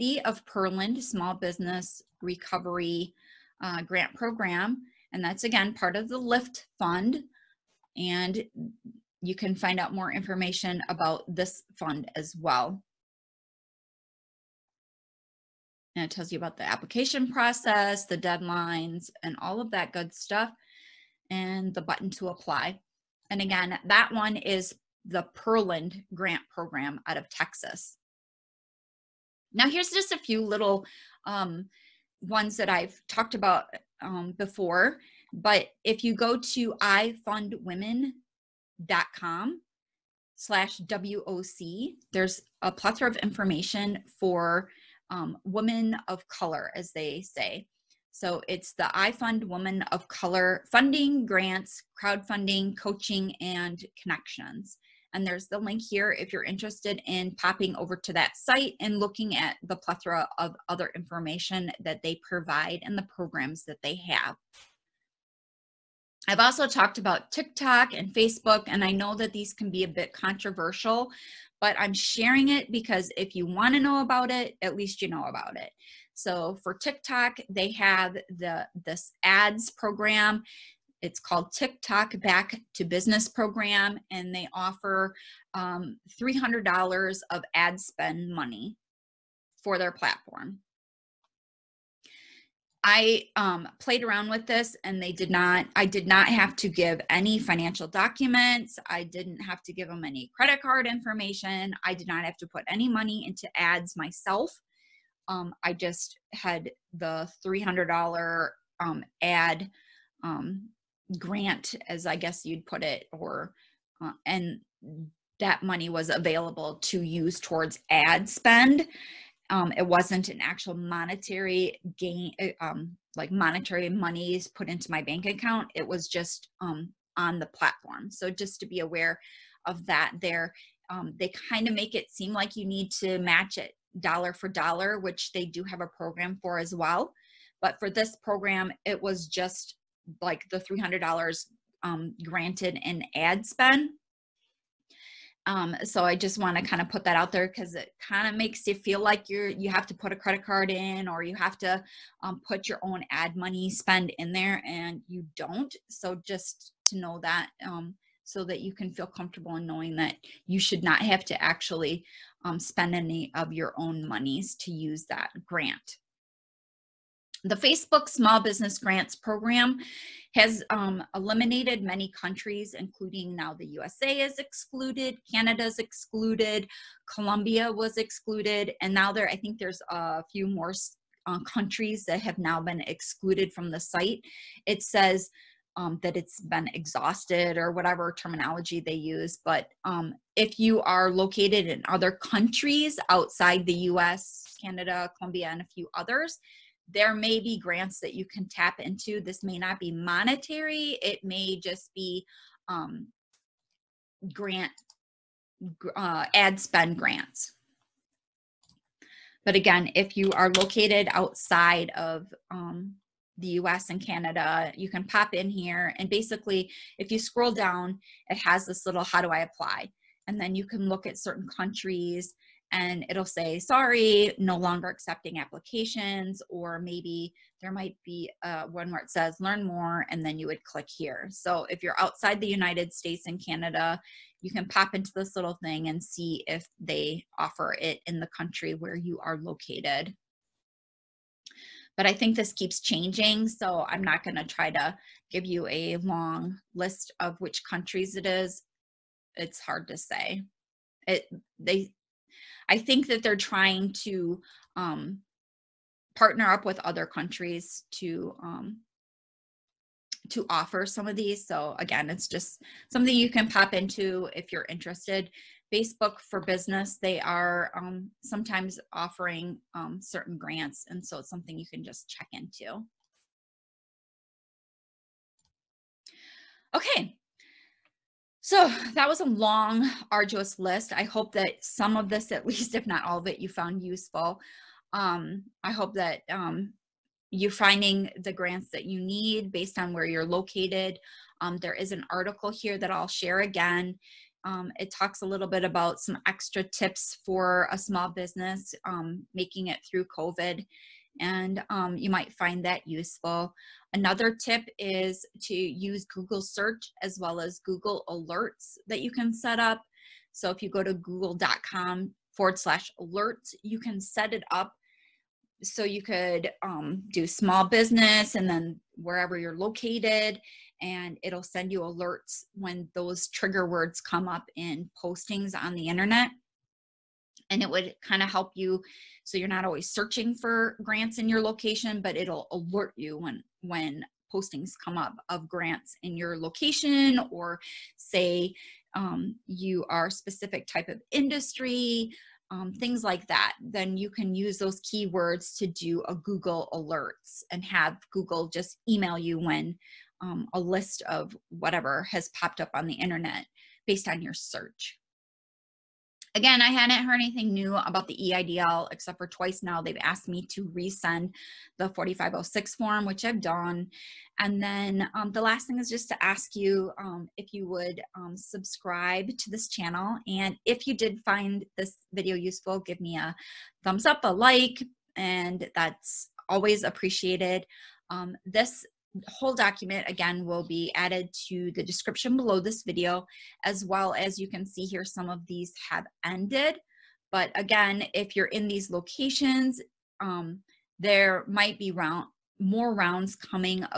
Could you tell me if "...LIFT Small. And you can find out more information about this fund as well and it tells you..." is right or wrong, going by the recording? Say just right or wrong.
wrong.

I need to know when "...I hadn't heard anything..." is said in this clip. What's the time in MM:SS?
05:56.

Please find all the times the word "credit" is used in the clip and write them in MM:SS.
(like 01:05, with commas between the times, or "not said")
01:40, 02:30.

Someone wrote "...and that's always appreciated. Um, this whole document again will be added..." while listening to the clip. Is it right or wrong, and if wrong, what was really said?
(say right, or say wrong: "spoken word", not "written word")
right.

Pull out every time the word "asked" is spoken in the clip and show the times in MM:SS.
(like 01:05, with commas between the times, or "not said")
06:00.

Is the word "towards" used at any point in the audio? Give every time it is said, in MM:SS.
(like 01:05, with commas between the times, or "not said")
01:57.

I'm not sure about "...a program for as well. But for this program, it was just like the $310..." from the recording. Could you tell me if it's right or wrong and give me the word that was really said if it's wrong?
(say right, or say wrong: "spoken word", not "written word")
wrong: "300", not "310".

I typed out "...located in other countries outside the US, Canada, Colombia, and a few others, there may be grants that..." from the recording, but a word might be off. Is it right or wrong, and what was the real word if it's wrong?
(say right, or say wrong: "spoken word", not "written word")
right.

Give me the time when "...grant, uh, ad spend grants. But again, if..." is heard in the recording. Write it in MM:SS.
03:24.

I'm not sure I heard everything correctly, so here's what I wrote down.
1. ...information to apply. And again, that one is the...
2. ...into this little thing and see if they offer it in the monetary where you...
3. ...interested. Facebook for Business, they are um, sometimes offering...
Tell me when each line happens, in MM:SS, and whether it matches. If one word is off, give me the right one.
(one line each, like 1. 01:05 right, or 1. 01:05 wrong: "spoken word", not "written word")
1. 00:21 wrong: "button", not "information"
2. 03:54 wrong: "country", not "monetary"
3. 04:24 right.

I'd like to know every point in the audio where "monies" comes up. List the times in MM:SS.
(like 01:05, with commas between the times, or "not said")
02:03, 02:44.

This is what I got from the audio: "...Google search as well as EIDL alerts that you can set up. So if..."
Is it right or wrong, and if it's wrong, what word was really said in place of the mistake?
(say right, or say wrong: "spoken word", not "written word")
wrong: "Google", not "EIDL".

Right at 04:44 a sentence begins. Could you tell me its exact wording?
Um, I hope that um, you're finding the grants that you need based on where you're located.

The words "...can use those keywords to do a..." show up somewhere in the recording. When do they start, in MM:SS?
05:44.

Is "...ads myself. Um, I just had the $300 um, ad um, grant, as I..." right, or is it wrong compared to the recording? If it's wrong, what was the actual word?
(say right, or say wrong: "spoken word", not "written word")
right.